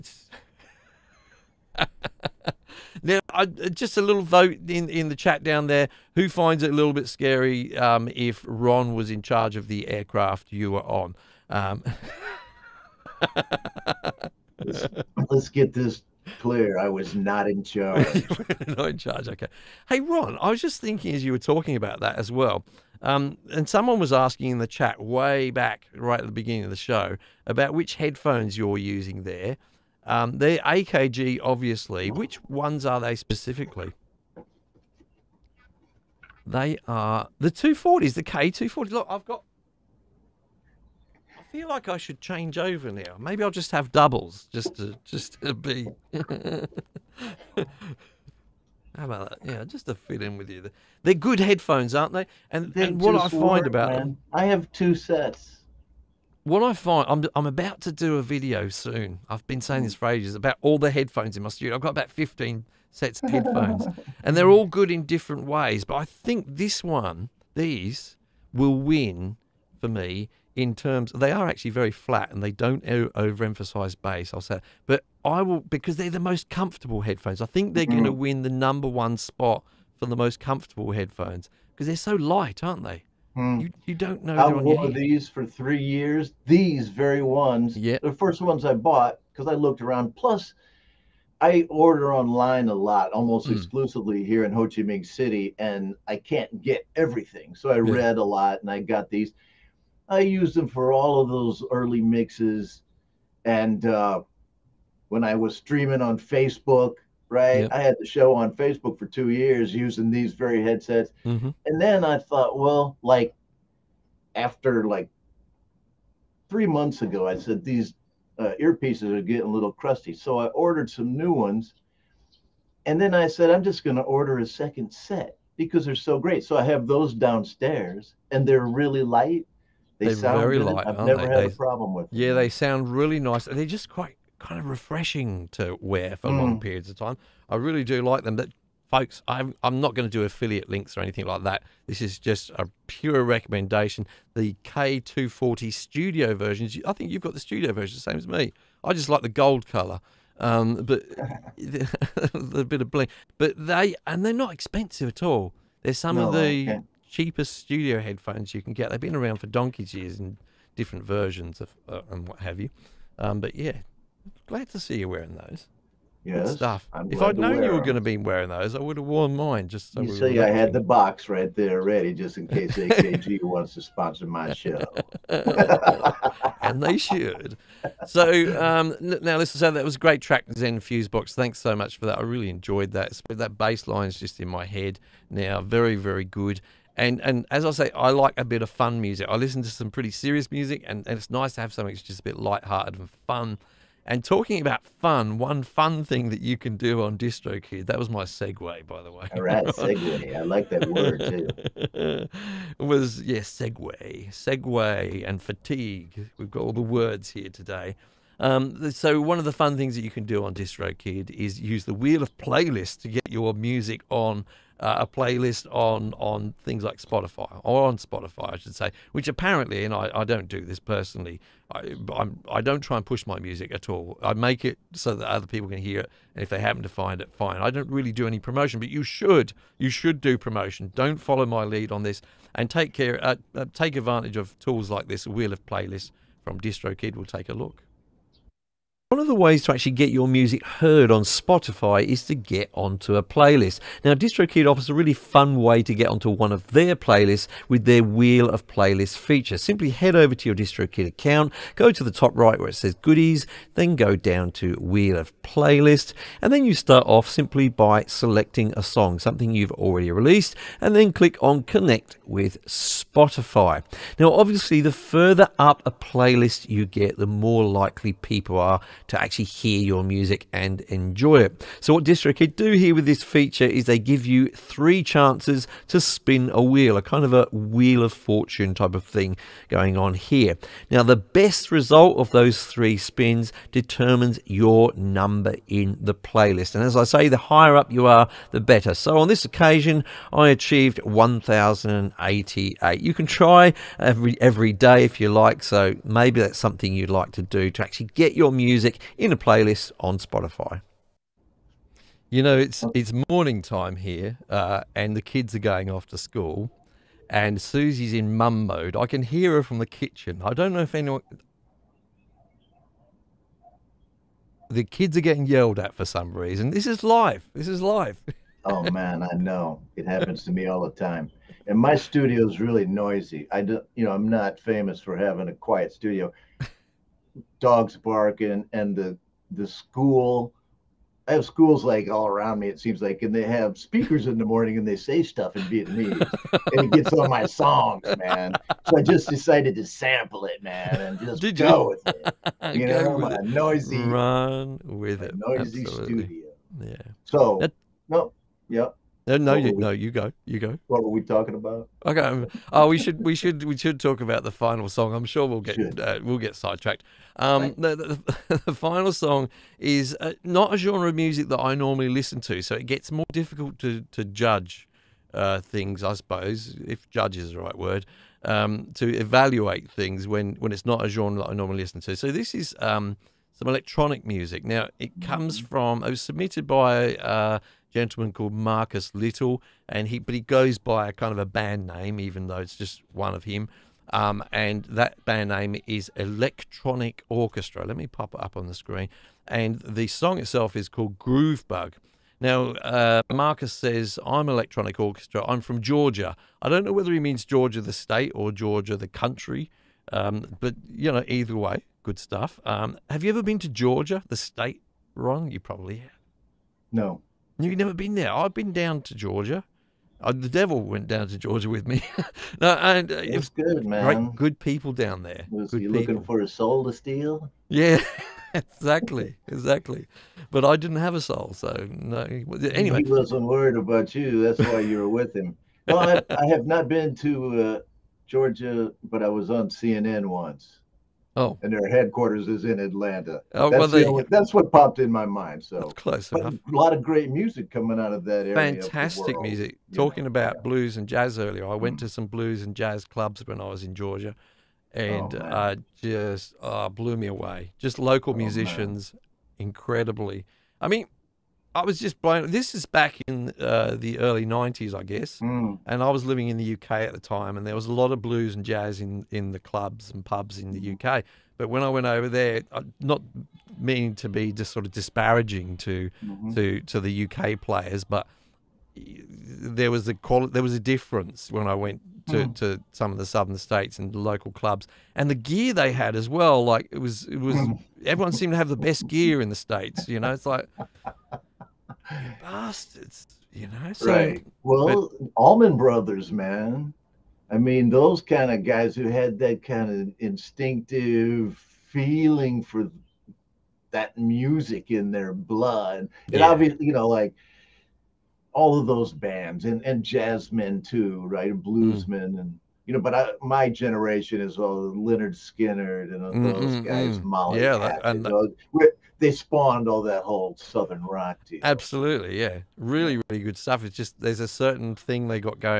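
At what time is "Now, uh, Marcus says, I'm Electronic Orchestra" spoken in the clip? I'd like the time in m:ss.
6:32.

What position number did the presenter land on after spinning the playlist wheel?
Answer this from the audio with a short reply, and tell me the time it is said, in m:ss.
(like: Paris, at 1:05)
1,088, at 4:51.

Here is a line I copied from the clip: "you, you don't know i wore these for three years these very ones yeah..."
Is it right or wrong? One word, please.
right.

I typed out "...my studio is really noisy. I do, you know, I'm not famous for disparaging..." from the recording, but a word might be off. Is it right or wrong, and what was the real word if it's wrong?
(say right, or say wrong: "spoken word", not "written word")
wrong: "having", not "disparaging".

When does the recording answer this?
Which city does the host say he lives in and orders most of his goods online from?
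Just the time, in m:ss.
1:34.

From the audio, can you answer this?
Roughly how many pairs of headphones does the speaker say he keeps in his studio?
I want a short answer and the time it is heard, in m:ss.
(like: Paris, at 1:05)
15, at 1:02.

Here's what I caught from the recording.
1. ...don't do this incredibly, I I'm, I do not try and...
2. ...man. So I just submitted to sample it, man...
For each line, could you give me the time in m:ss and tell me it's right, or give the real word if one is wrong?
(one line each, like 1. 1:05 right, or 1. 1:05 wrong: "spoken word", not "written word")
1. 3:40 wrong: "personally", not "incredibly"
2. 5:38 wrong: "decided", not "submitted".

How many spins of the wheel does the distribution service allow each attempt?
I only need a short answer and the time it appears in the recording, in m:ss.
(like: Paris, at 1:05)
3, at 4:34.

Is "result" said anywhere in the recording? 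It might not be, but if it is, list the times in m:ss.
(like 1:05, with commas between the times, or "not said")
4:41.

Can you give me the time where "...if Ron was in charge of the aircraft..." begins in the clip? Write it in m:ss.
0:08.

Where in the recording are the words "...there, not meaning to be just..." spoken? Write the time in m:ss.
7:42.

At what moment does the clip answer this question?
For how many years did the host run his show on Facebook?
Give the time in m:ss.
1:49.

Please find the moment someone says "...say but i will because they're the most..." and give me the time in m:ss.
1:14.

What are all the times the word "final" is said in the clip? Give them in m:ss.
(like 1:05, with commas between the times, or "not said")
5:54, 5:58.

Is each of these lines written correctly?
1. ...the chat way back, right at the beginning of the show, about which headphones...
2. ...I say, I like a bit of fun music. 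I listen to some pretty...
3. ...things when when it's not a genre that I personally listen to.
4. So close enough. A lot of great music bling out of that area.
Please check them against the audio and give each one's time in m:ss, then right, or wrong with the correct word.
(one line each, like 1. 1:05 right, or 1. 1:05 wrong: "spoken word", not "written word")
1. 0:24 right
2. 3:07 right
3. 6:09 wrong: "normally", not "personally"
4. 7:15 wrong: "coming", not "bling".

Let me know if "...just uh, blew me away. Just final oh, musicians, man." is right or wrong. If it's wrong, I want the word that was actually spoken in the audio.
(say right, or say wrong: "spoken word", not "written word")
wrong: "local", not "final".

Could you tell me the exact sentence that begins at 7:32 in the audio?
This is back in uh, the early '90s, I guess, mm.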